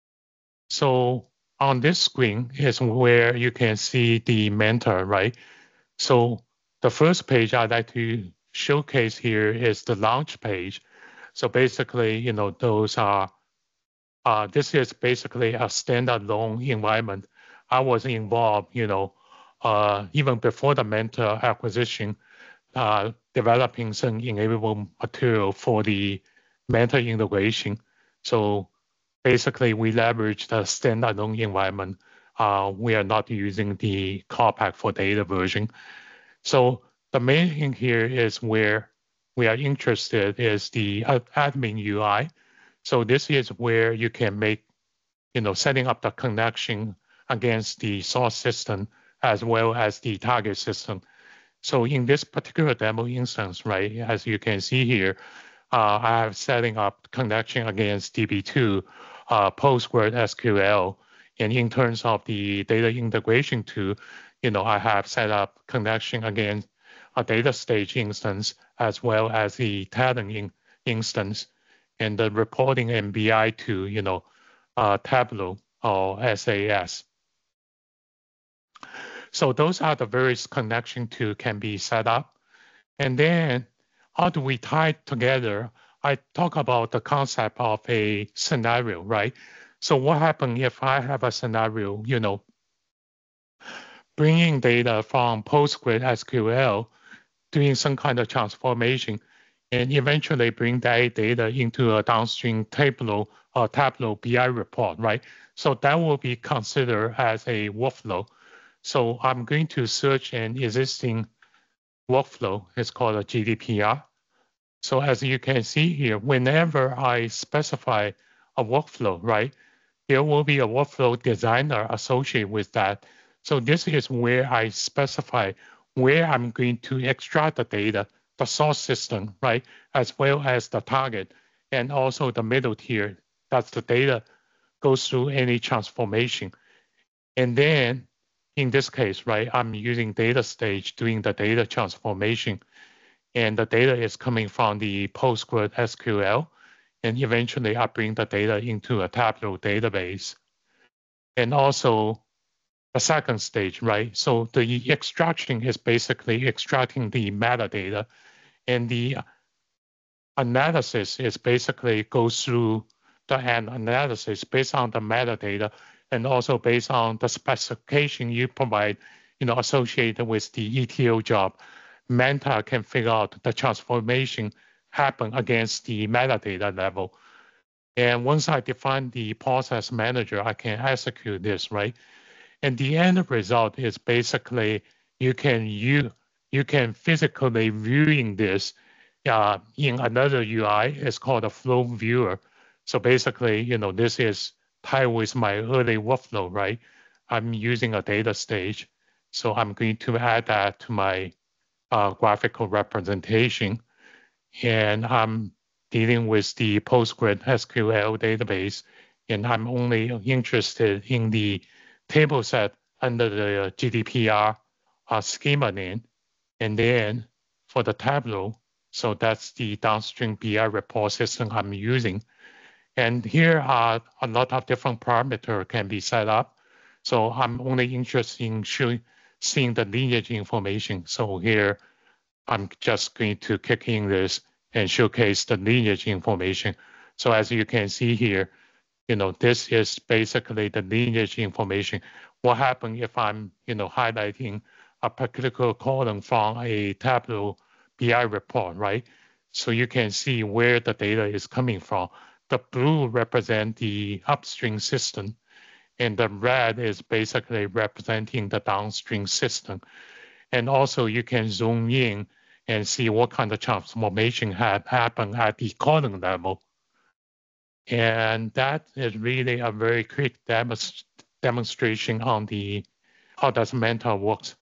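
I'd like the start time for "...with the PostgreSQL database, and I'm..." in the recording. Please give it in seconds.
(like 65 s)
206 s.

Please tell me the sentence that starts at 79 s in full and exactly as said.
So those are the various connection to can be set up.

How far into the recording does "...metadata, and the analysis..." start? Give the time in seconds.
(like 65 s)
157 s.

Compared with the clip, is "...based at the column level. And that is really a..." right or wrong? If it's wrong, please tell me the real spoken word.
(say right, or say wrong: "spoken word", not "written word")
wrong: "happened", not "based".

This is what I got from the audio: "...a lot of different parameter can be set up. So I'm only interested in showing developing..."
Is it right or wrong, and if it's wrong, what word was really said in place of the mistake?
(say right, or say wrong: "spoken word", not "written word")
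wrong: "seeing", not "developing".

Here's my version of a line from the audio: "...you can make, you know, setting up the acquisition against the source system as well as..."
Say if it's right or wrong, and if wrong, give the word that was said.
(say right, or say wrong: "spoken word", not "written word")
wrong: "connection", not "acquisition".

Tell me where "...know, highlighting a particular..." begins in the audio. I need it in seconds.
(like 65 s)
243 s.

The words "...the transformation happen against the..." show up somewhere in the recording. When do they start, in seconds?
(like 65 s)
173 s.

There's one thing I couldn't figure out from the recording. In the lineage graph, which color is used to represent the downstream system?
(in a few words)
red.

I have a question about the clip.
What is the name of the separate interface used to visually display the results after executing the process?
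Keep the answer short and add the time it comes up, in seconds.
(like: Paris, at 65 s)
flow viewer, at 191 s.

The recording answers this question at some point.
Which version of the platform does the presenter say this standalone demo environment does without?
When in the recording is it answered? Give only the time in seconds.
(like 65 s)
34 s.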